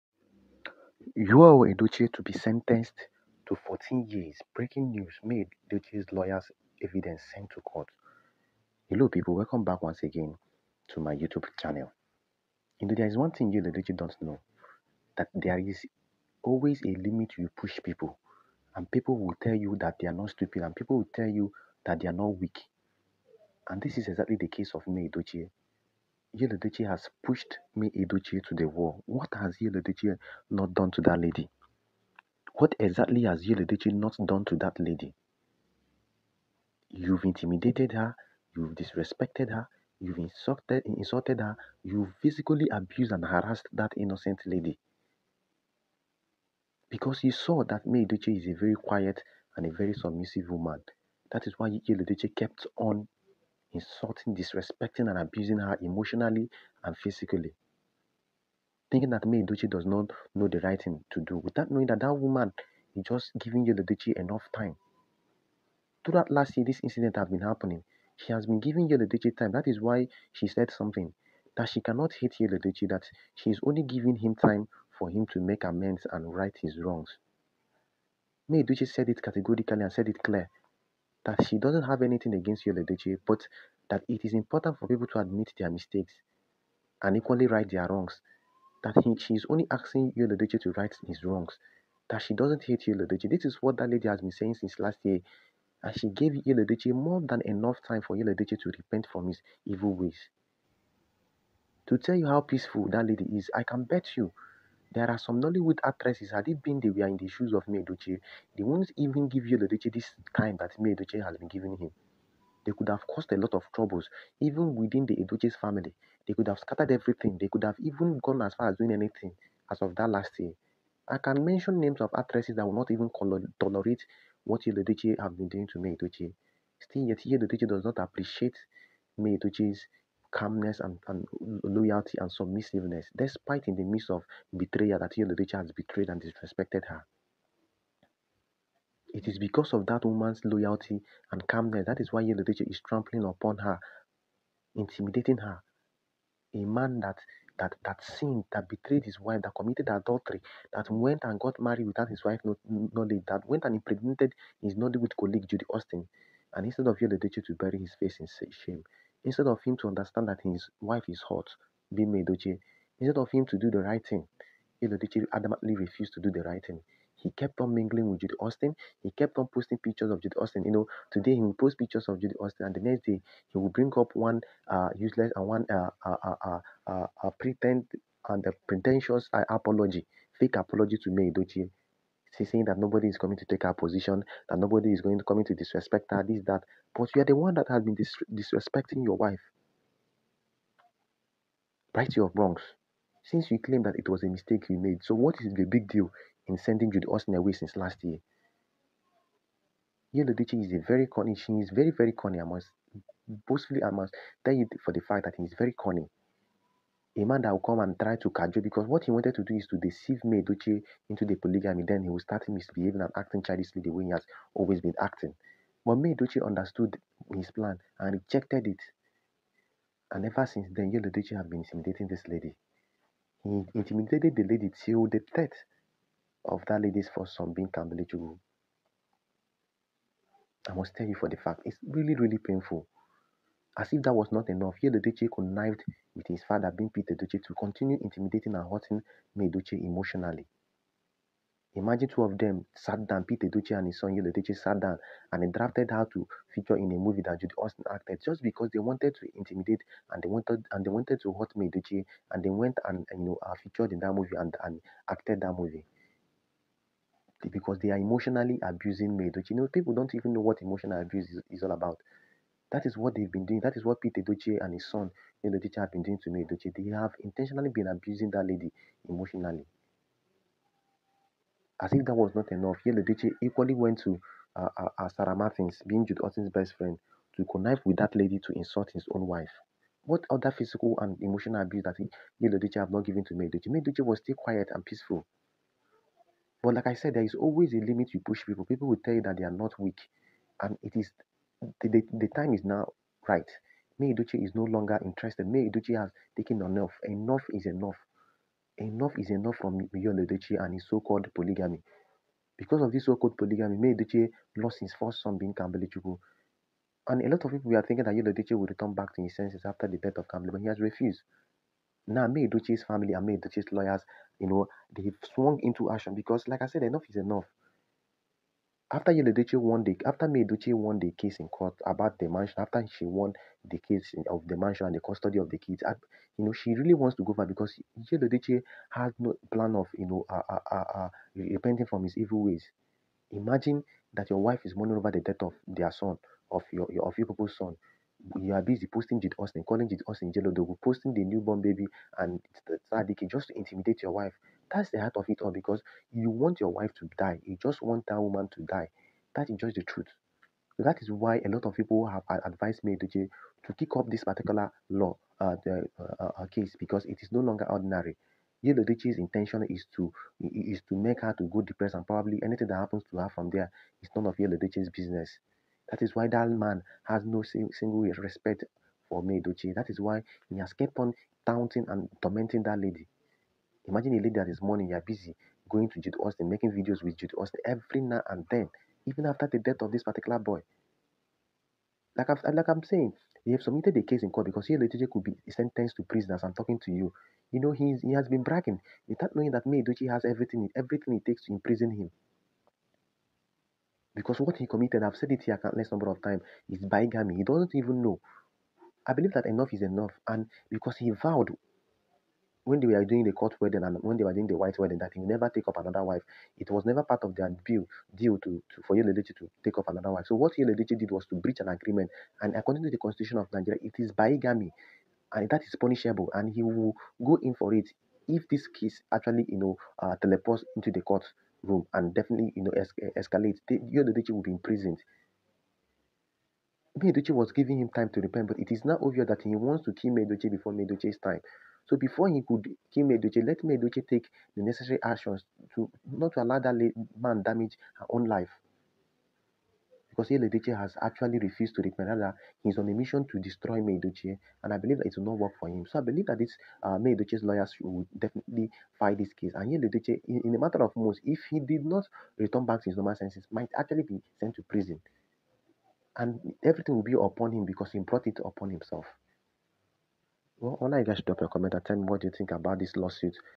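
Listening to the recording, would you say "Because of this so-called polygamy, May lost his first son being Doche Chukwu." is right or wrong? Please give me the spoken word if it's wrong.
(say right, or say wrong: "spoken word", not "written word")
wrong: "Kambili", not "Doche".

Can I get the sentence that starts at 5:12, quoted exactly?
Now, May family and May lawyers, you know, they've swung into action because, like I said, enough is enough.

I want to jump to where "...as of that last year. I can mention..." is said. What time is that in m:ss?
1:59.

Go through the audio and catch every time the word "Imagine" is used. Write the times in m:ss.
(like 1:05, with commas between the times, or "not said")
4:01, 5:33, 6:13.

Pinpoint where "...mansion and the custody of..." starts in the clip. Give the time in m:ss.
5:24.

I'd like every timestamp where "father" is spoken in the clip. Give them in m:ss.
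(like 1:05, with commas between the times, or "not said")
3:56.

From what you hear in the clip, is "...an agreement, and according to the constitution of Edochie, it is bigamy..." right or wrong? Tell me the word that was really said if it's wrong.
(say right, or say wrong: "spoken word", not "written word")
wrong: "Nigeria", not "Edochie".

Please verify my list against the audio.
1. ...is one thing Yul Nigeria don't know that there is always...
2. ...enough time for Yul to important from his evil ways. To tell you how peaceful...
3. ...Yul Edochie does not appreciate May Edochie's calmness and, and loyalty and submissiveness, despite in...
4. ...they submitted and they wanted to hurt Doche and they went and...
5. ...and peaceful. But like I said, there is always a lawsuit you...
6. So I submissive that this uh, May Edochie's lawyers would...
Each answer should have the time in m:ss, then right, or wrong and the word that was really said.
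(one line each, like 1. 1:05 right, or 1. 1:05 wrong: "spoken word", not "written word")
1. 0:13 wrong: "Edochie", not "Nigeria"
2. 1:37 wrong: "repent", not "important"
3. 2:07 right
4. 4:10 wrong: "wanted", not "submitted"
5. 4:44 wrong: "limit", not "lawsuit"
6. 7:25 wrong: "believe", not "submissive".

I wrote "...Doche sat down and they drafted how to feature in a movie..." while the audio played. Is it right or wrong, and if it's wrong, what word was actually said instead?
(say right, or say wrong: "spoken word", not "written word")
right.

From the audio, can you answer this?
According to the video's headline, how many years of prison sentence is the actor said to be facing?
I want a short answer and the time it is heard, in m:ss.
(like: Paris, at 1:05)
14 years, at 0:03.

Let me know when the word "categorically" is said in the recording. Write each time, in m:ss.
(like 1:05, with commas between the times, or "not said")
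1:19.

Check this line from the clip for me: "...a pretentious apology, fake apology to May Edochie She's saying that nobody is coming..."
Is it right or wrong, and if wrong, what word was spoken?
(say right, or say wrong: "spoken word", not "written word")
right.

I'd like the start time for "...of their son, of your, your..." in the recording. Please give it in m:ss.
5:35.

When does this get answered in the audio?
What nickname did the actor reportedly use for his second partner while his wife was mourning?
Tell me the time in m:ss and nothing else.
5:40.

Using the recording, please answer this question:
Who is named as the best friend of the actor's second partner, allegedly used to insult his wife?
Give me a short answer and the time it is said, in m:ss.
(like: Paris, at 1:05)
Sarah Martins, at 4:35.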